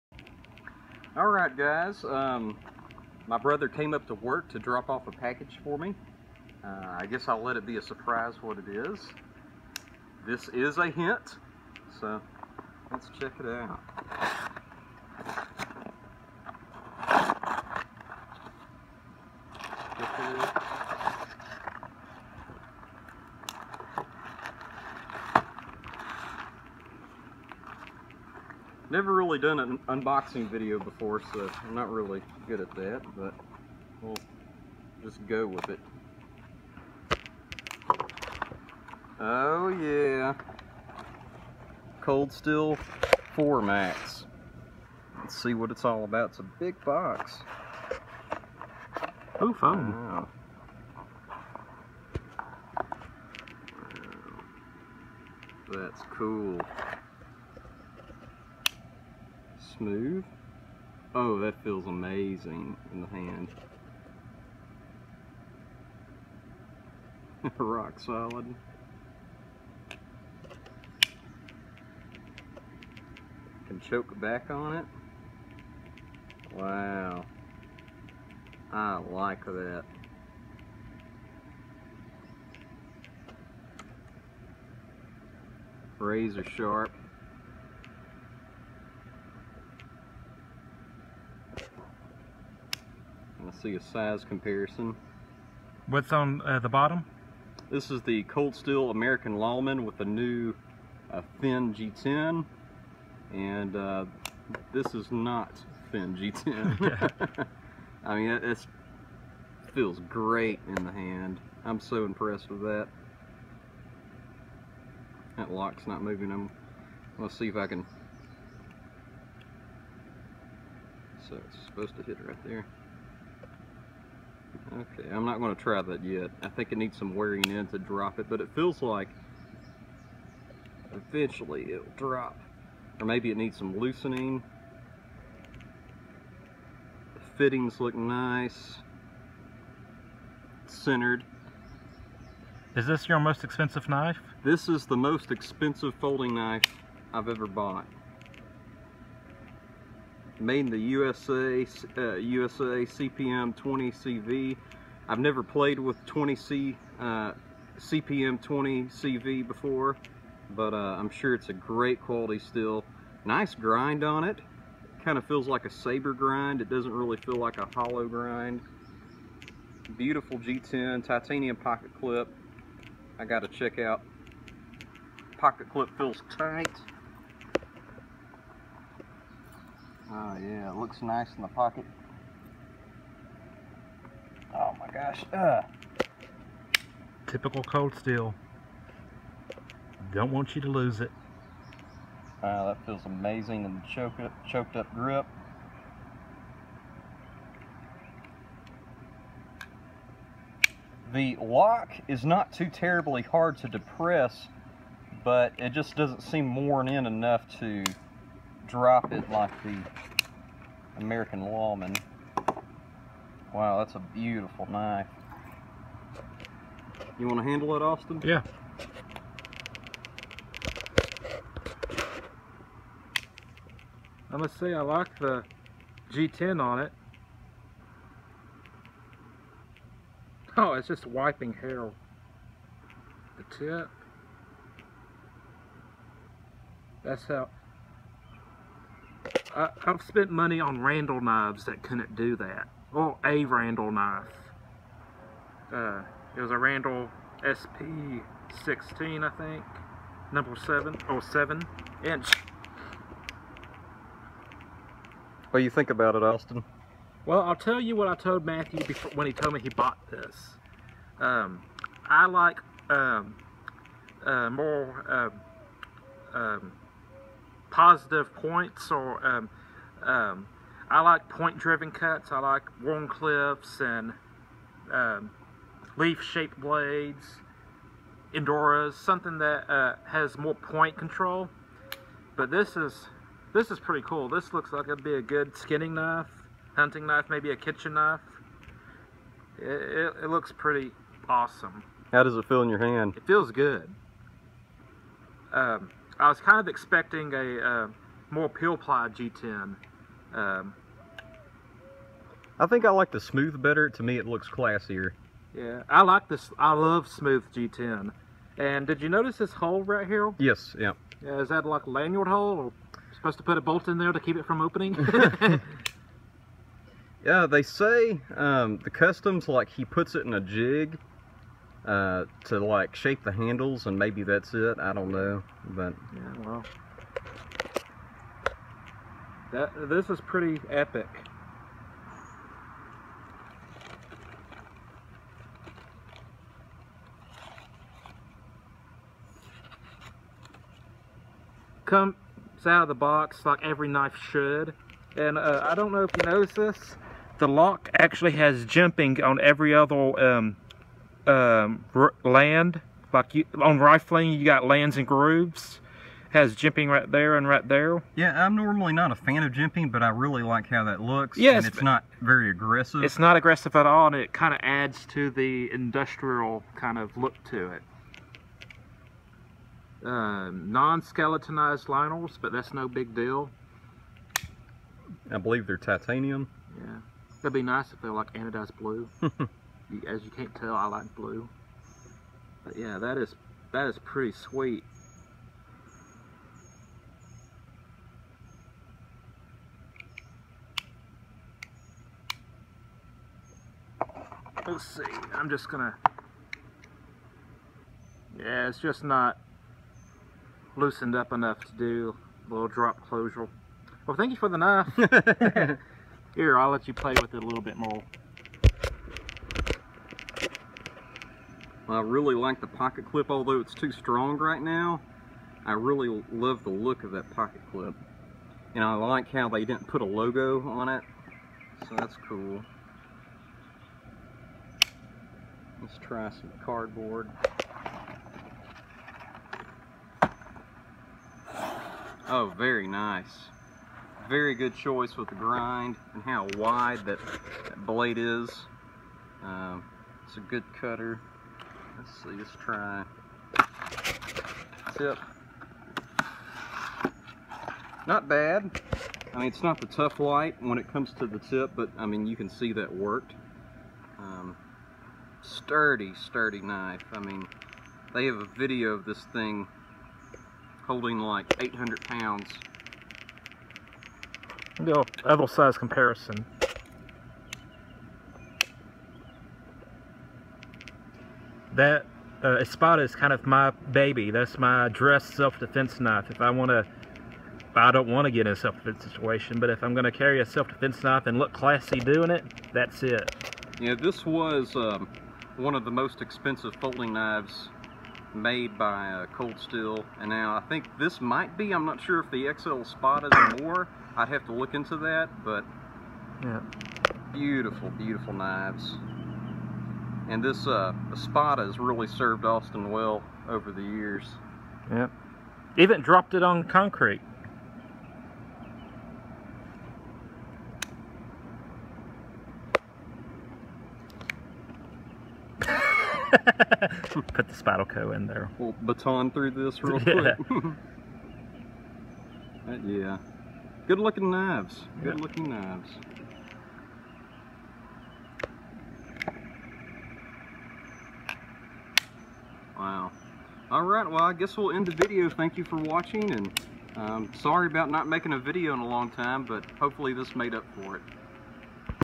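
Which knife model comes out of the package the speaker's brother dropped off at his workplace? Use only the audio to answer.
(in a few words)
Cold Steel 4 Max.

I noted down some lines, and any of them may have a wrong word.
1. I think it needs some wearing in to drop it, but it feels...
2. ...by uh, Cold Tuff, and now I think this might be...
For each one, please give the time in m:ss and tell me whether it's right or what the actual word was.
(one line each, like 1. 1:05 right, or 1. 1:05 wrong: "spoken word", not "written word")
1. 2:06 right
2. 8:08 wrong: "Steel", not "Tuff".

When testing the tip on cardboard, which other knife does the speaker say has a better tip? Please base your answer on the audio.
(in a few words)
Tuff Lite.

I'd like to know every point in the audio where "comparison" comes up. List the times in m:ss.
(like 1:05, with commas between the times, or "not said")
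1:34, 7:45.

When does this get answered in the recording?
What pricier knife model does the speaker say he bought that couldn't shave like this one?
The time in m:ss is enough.
4:07.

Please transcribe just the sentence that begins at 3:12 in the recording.
Wow, that feels amazing in the choke up, choked up grip.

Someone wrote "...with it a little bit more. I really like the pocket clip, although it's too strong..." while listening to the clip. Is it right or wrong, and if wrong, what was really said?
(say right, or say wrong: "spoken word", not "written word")
right.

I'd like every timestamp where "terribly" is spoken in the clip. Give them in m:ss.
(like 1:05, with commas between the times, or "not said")
3:22.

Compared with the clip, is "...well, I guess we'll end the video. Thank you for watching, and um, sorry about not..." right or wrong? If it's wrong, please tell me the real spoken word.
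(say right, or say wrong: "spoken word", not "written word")
right.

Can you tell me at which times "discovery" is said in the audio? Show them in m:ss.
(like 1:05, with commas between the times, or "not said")
not said.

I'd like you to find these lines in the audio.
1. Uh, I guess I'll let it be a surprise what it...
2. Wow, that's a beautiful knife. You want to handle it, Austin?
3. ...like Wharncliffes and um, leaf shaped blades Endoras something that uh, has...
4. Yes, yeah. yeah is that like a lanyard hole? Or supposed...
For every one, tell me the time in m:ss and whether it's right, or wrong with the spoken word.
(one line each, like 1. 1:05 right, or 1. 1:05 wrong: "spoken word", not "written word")
1. 0:06 right
2. 3:33 right
3. 4:32 right
4. 5:10 right.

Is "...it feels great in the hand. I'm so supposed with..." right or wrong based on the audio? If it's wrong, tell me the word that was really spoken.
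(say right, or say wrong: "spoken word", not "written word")
wrong: "impressed", not "supposed".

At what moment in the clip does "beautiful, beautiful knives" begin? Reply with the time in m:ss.
8:17.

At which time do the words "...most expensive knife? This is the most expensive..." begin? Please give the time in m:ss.
2:23.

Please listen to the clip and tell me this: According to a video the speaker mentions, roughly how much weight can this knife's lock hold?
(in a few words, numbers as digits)
800 pounds.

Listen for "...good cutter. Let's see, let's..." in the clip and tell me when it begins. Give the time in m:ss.
7:20.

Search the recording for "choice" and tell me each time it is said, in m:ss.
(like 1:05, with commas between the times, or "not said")
7:14.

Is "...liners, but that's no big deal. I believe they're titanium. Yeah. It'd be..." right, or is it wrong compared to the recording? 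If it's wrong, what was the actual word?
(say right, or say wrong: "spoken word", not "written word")
right.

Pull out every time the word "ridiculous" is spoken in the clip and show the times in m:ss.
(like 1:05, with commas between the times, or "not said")
not said.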